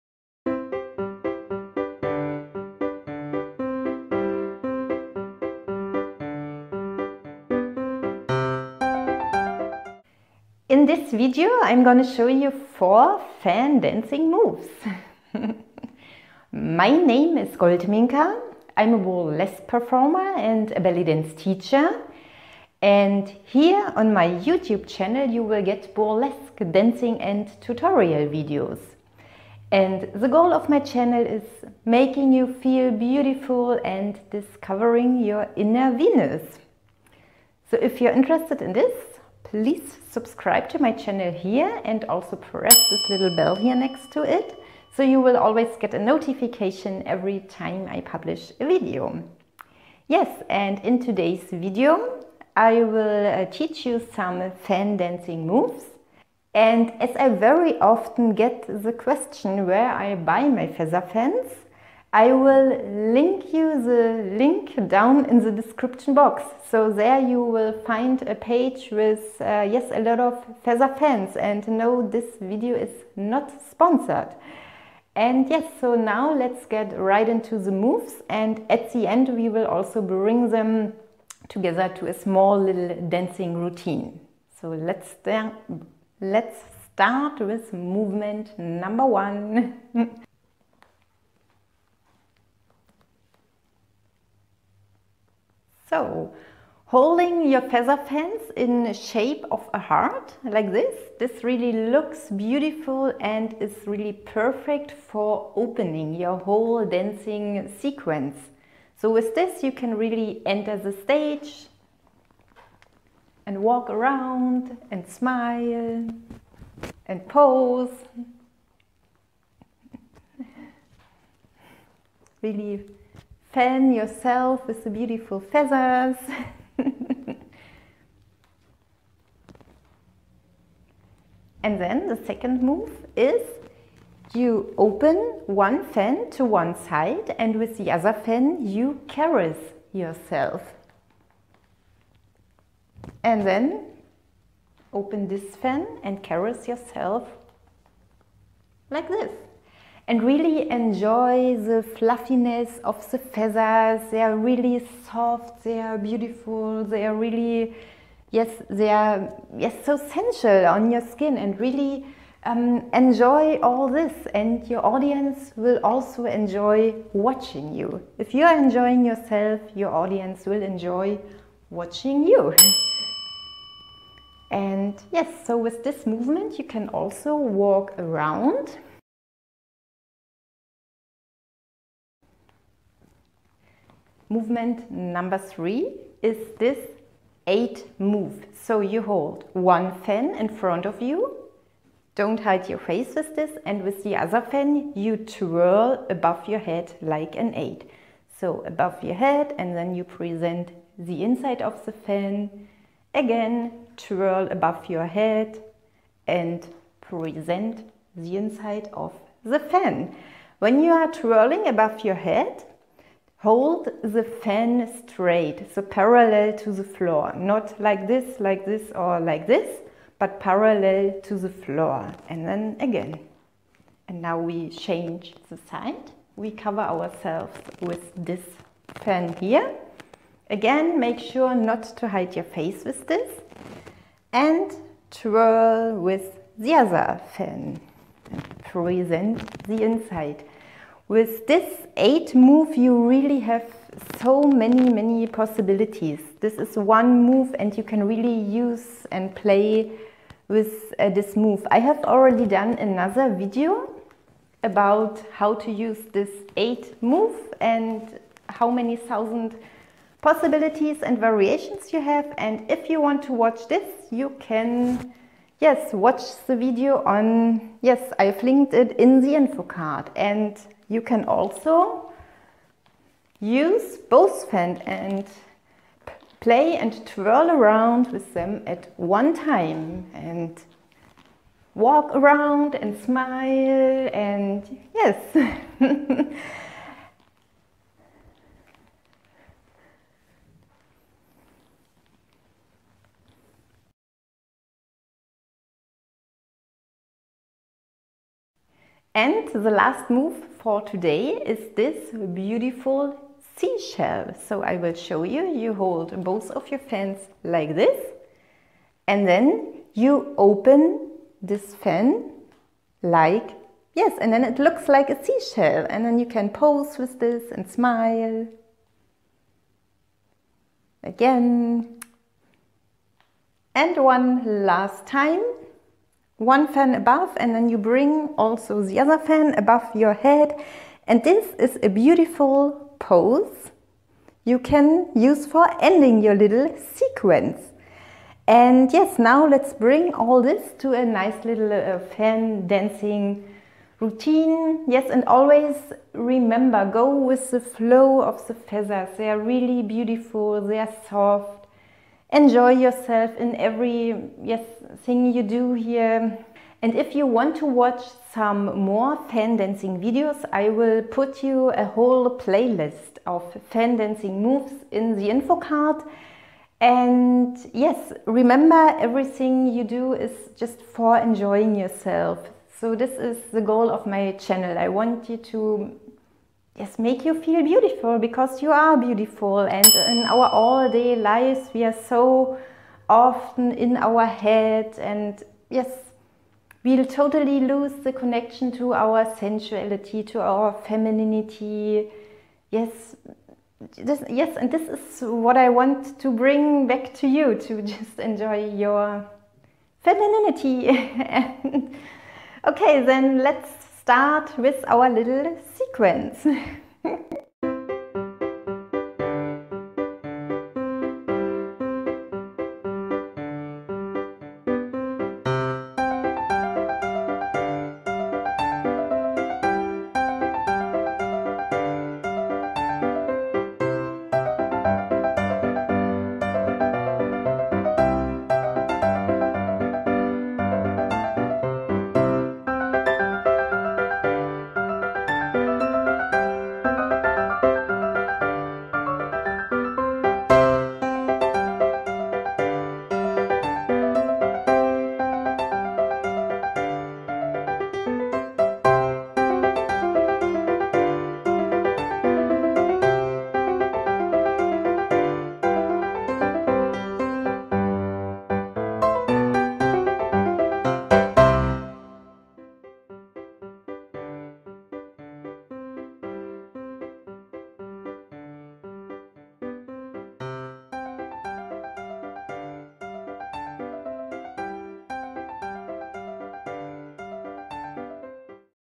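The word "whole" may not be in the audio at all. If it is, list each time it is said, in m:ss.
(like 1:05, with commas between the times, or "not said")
1:46, 6:01.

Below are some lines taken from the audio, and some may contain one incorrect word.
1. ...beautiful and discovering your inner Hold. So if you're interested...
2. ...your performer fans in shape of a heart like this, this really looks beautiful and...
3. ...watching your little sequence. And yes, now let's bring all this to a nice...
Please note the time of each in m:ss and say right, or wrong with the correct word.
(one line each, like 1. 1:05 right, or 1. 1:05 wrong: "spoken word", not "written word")
1. 0:32 wrong: "Venus", not "Hold"
2. 1:37 wrong: "feather", not "performer"
3. 5:35 wrong: "ending", not "watching".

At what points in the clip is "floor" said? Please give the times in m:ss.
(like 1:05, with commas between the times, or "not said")
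3:36, 3:41.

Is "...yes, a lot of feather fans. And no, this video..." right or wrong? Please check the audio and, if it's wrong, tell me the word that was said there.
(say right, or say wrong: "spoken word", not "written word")
right.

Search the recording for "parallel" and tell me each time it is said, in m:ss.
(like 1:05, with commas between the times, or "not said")
3:35, 3:40.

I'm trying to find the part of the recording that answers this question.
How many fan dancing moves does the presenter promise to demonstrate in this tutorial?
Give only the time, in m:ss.
0:12.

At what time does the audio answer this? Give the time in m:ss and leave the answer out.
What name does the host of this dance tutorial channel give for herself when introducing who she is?
0:17.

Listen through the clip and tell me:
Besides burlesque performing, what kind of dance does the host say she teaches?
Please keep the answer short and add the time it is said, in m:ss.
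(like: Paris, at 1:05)
belly dance, at 0:20.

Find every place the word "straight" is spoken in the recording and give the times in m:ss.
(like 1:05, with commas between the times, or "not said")
3:35.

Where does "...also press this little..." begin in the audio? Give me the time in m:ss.
0:42.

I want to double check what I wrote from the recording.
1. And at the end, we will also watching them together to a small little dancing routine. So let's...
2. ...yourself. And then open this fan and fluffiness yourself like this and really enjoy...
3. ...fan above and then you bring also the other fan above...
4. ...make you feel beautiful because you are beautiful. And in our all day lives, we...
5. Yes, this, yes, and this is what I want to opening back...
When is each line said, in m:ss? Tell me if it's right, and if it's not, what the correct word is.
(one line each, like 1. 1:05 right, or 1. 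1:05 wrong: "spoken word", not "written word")
1. 1:18 wrong: "bring", not "watching"
2. 2:19 wrong: "caress", not "fluffiness"
3. 5:26 right
4. 6:16 right
5. 6:32 wrong: "bring", not "opening".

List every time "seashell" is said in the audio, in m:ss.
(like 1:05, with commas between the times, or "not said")
5:03, 5:15.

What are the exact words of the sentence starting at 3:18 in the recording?
So above your head and then you present the inside of the fan.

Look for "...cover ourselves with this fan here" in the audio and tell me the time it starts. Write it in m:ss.
3:46.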